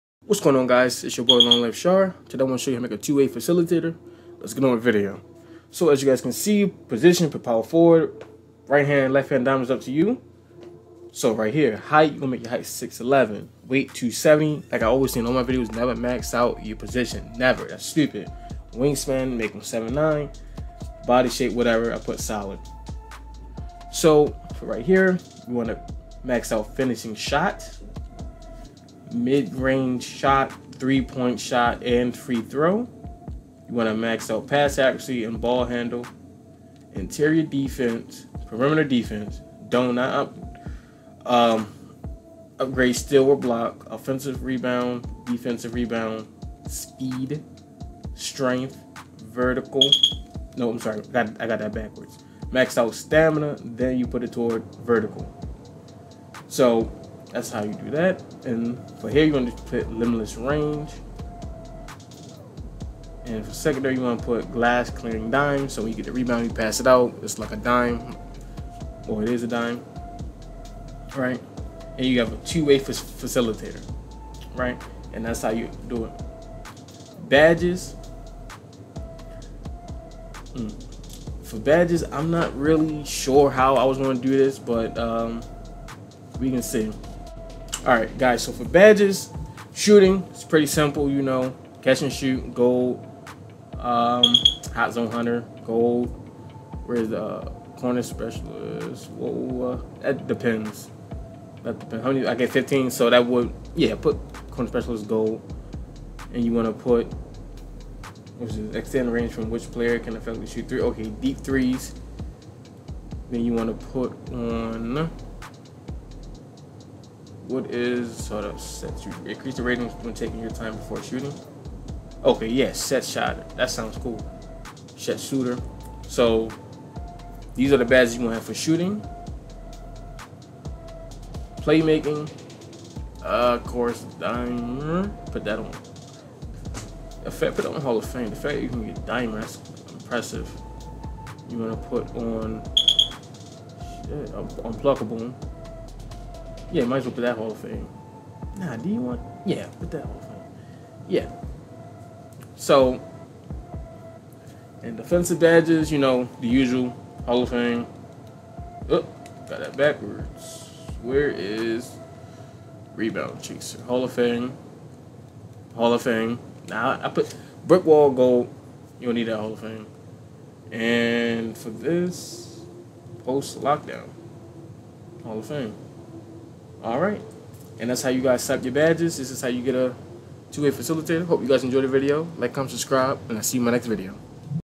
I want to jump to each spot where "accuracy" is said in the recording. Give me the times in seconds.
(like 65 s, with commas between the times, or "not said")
34 s.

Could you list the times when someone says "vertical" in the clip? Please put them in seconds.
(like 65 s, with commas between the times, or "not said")
49 s, 54 s.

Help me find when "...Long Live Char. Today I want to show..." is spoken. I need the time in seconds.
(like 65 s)
1 s.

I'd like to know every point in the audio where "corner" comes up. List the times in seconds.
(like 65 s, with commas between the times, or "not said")
97 s, 104 s.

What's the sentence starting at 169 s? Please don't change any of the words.
You'll need that Hall of Fame.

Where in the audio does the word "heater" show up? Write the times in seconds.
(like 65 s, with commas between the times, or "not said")
not said.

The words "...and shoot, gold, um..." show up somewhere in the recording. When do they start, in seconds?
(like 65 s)
92 s.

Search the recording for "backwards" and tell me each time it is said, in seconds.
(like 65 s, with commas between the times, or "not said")
51 s, 159 s.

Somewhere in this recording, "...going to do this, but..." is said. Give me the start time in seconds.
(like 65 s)
83 s.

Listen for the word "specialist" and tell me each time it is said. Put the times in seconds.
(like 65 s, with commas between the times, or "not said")
98 s, 104 s.